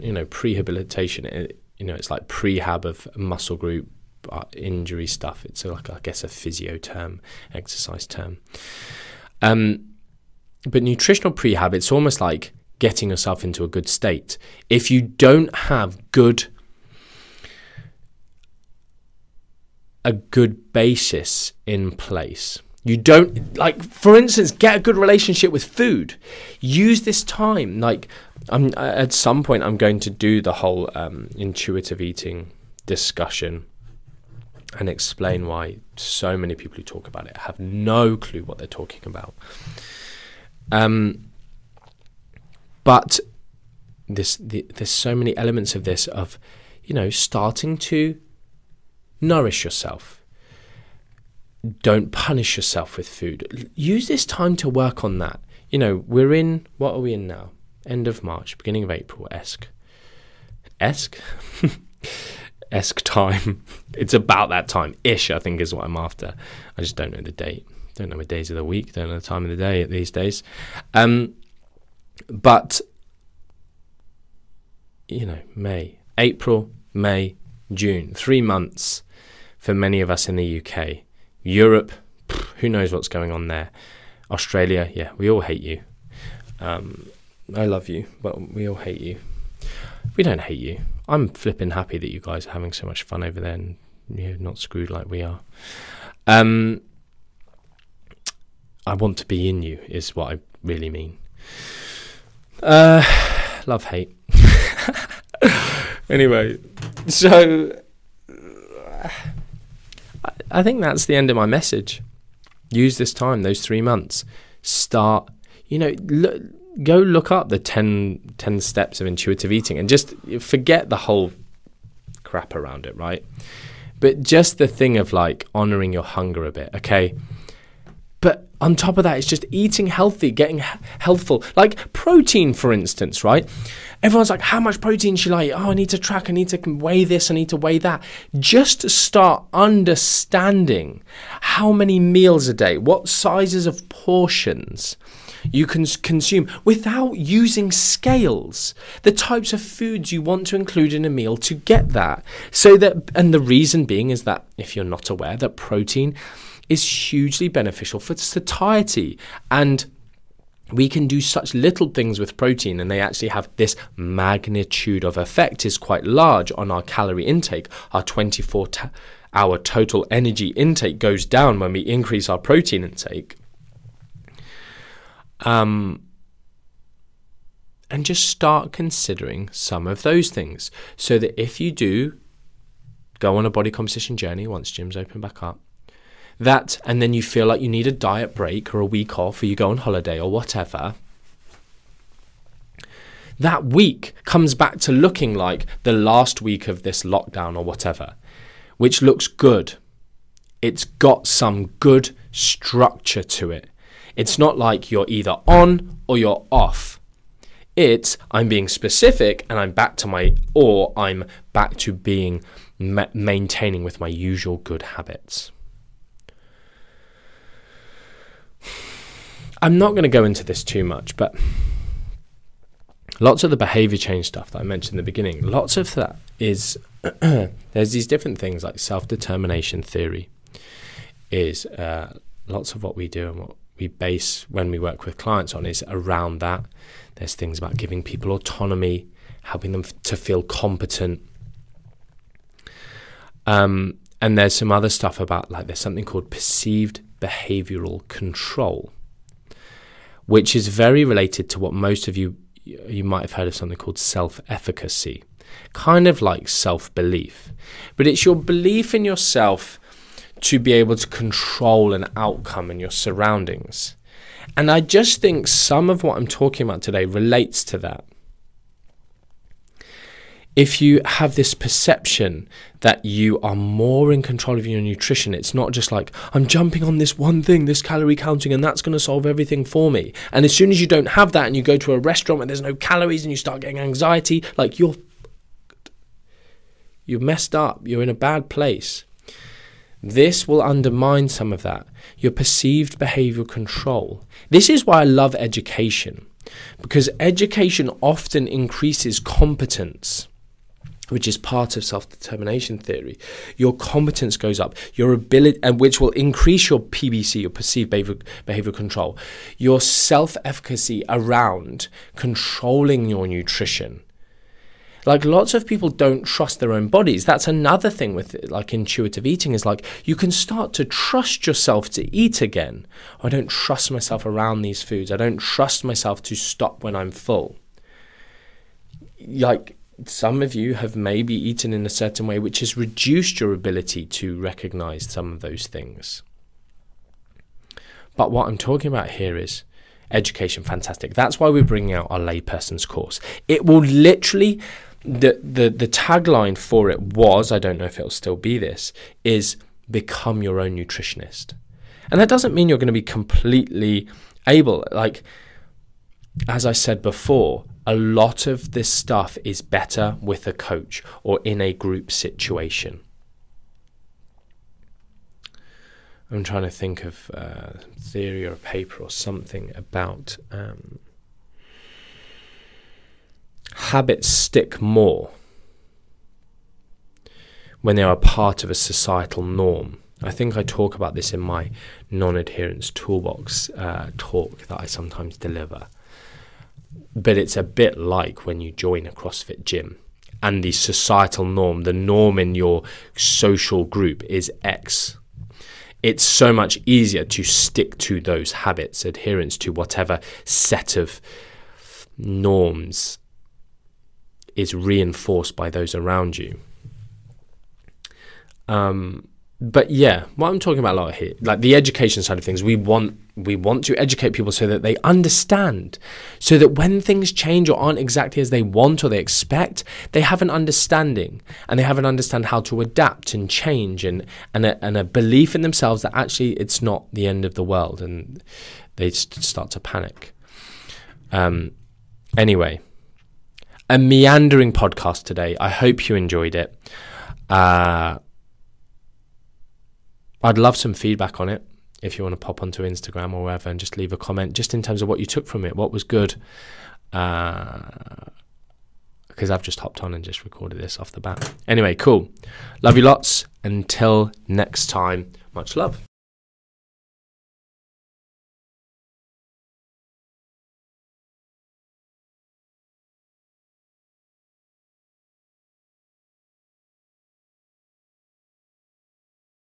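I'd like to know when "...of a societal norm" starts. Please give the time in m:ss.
6:18.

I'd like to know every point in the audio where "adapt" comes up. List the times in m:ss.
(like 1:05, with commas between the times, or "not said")
7:02.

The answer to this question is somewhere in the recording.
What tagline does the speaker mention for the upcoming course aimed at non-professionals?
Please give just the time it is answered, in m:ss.
5:49.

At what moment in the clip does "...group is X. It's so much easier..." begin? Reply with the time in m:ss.
6:33.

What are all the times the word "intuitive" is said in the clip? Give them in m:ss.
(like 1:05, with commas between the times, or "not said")
0:31, 1:59, 5:18.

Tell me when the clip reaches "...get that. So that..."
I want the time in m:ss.
2:31.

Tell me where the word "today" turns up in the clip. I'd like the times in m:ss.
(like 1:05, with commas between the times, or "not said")
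4:26, 7:15.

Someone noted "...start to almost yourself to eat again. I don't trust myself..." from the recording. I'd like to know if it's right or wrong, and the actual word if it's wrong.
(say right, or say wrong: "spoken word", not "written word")
wrong: "trust", not "almost".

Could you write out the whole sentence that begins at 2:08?
But on top of that, it's just eating healthy, getting healthful.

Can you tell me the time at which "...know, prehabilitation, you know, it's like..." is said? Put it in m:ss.
0:00.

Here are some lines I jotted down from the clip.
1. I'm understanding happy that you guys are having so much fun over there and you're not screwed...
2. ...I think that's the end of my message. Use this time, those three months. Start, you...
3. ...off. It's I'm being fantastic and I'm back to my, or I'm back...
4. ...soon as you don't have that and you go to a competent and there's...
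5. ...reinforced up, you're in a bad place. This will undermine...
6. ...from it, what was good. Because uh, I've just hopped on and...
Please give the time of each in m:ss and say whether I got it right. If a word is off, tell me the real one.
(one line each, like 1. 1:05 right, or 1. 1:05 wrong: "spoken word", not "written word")
1. 1:31 wrong: "flipping", not "understanding"
2. 1:50 right
3. 3:26 wrong: "specific", not "fantastic"
4. 4:40 wrong: "restaurant", not "competent"
5. 4:47 wrong: "messed", not "reinforced"
6. 7:25 right.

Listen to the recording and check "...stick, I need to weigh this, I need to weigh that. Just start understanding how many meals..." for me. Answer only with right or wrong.
wrong.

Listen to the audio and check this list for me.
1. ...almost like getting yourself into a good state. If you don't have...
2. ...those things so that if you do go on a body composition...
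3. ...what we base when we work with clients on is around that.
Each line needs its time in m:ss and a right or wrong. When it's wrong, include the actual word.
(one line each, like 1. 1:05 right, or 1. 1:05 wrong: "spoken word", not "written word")
1. 0:11 right
2. 3:00 right
3. 3:53 right.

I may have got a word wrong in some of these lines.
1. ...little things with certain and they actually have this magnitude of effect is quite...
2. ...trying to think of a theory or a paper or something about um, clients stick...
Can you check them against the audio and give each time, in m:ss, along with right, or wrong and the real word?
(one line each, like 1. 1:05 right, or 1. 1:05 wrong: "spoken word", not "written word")
1. 2:41 wrong: "protein", not "certain"
2. 6:06 wrong: "habits", not "clients".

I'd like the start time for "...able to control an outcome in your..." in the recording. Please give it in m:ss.
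4:20.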